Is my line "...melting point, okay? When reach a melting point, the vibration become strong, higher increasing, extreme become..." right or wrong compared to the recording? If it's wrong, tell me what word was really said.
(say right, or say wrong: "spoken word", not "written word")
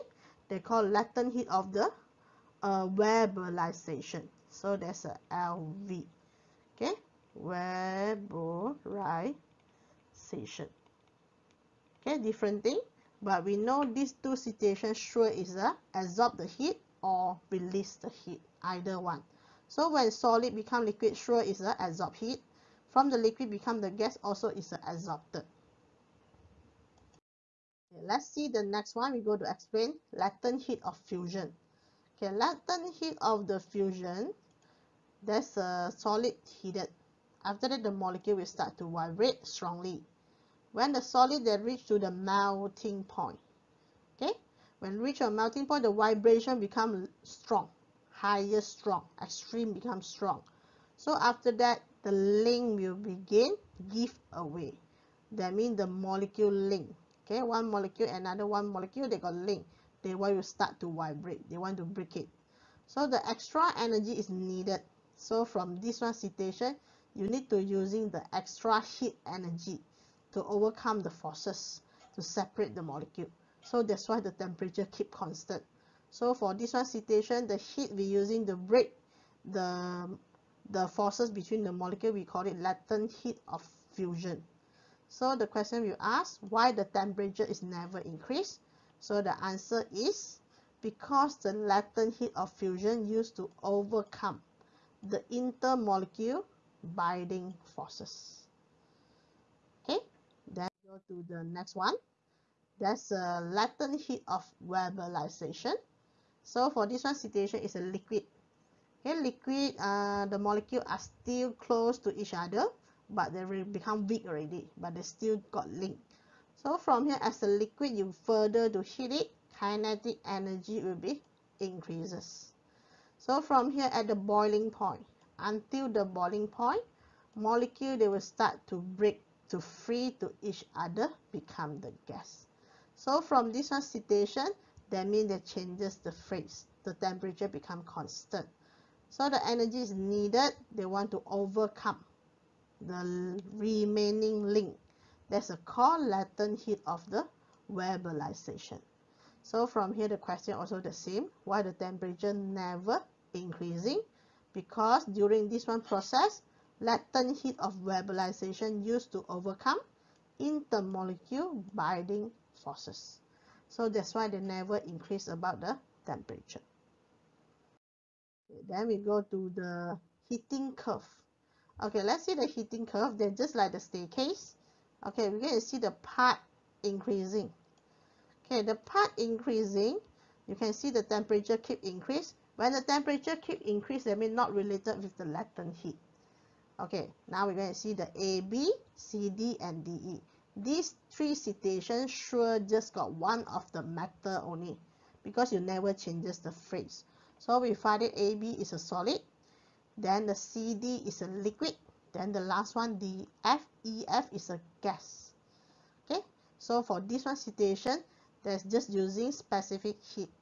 wrong: "strong", not "increasing".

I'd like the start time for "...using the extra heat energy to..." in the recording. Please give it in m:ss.
1:07.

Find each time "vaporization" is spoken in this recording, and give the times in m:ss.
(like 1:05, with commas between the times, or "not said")
0:02, 0:07, 1:44, 2:27, 2:37.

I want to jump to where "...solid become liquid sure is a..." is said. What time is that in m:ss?
0:20.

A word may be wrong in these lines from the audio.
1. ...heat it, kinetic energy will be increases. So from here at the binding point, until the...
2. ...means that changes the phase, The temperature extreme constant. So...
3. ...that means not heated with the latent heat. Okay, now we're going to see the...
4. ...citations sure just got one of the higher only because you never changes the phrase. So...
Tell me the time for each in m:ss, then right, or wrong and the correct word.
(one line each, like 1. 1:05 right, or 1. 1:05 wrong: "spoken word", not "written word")
1. 1:58 wrong: "boiling", not "binding"
2. 2:15 wrong: "become", not "extreme"
3. 3:04 wrong: "related", not "heated"
4. 3:11 wrong: "matter", not "higher".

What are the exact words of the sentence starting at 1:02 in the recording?
So the extra energy is needed.